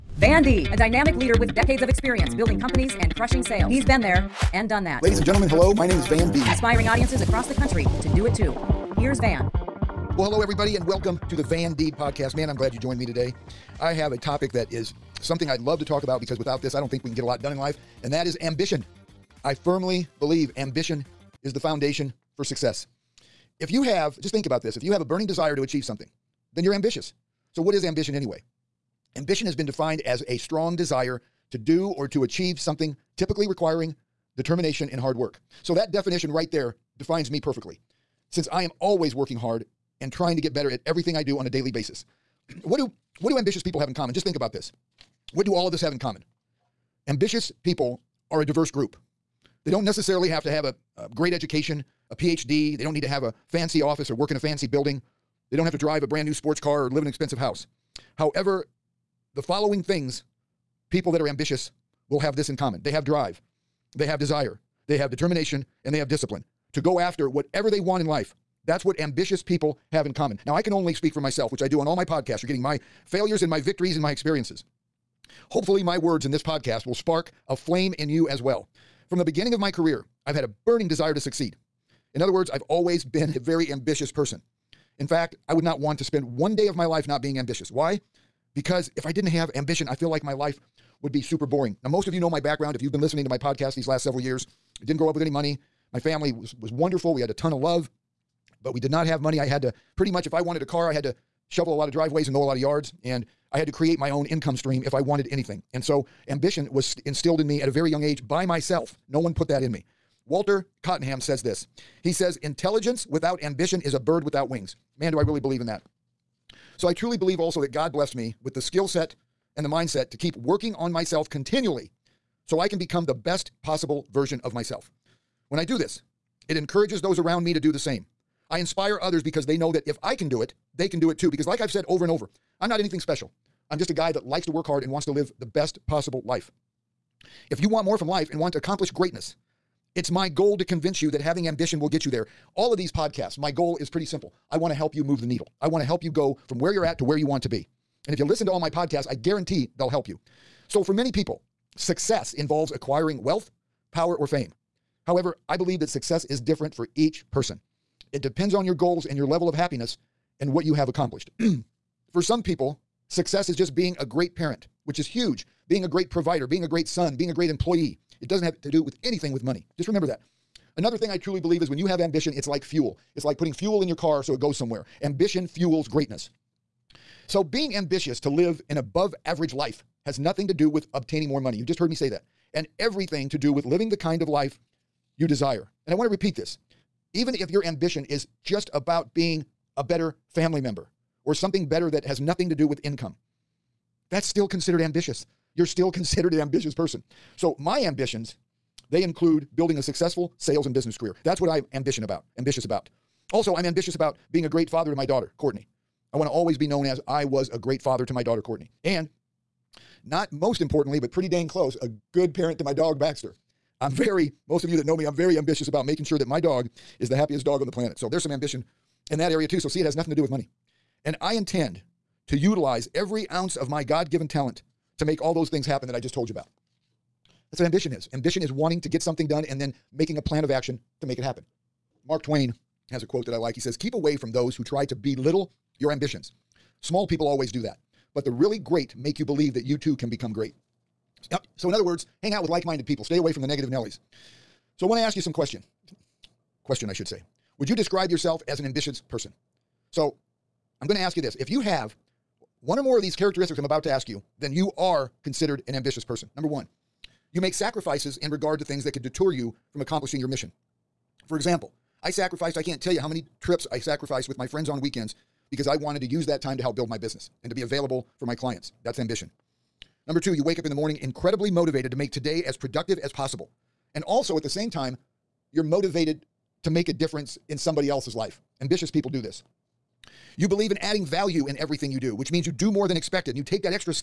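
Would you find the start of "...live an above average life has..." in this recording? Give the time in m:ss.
2:58.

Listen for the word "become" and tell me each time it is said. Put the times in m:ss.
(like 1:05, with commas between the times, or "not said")
2:02, 4:00.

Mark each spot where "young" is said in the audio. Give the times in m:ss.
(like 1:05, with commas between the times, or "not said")
1:47.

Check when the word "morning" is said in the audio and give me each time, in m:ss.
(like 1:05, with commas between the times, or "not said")
4:30.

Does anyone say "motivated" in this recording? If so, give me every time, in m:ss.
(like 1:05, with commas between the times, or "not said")
4:31, 4:35.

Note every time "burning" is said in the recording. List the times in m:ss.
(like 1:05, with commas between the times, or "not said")
0:25, 1:20.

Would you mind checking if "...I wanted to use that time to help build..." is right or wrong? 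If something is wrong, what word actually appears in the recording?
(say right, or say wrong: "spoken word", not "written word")
right.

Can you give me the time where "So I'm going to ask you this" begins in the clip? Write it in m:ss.
4:09.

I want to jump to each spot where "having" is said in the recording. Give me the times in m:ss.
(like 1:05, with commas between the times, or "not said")
2:21.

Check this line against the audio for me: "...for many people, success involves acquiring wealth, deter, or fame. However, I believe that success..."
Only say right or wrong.
wrong.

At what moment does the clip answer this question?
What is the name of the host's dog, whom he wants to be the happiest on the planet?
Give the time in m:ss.
3:32.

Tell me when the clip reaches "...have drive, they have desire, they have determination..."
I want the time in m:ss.
1:02.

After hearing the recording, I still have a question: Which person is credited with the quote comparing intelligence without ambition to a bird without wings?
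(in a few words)
Walter Cottingham.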